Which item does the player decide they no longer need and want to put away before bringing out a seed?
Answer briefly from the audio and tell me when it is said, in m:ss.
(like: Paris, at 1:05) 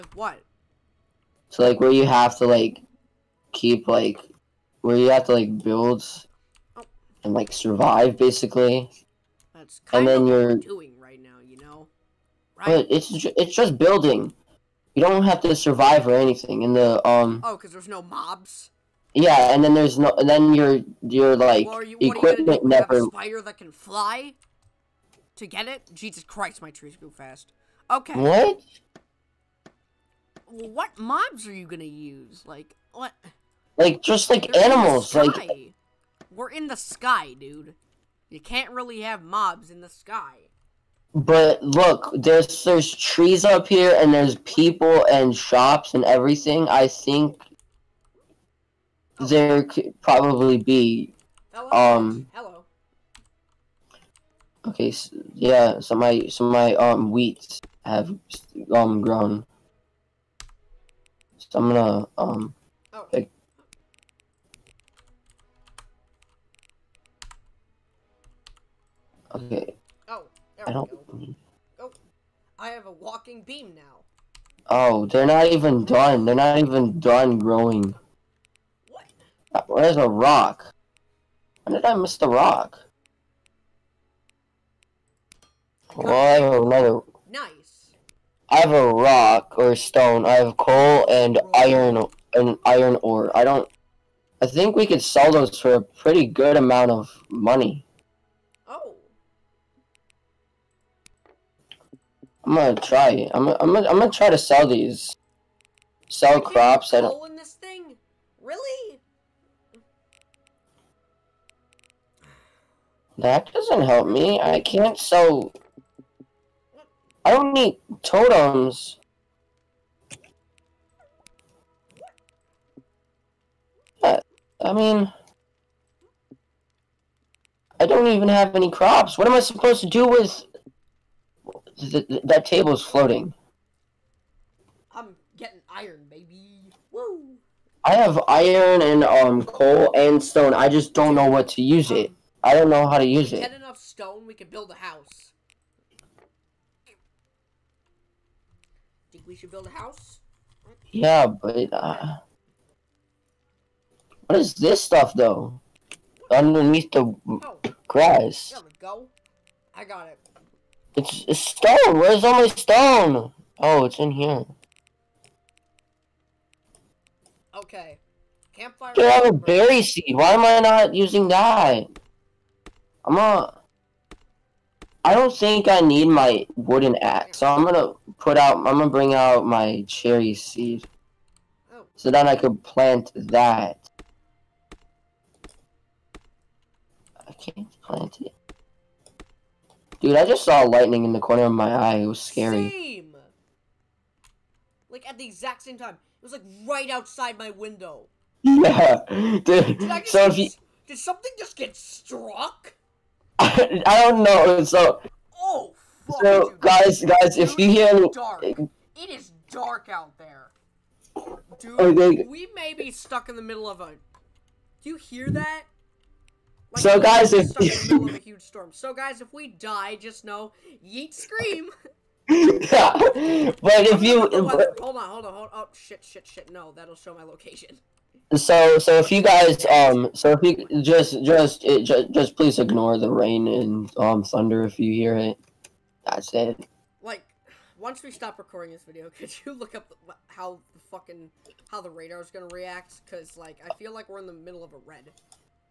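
wooden axe, at 2:56.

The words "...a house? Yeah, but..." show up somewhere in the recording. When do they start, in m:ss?
2:29.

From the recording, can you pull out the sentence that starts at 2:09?
What am I supposed to do with th that table is floating.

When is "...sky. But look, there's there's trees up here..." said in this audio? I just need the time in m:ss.
0:39.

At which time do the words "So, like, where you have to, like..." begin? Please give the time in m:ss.
0:01.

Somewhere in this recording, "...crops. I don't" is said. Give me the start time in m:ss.
1:46.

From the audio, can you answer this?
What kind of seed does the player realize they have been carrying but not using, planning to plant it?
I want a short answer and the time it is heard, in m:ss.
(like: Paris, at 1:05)
berry seed, at 2:49.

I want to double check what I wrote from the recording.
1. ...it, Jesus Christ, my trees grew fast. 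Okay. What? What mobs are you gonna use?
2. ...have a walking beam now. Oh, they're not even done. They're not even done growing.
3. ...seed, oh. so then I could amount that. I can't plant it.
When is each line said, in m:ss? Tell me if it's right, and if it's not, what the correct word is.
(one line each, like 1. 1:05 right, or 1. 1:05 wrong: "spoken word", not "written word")
1. 0:25 right
2. 1:12 right
3. 3:00 wrong: "plant", not "amount".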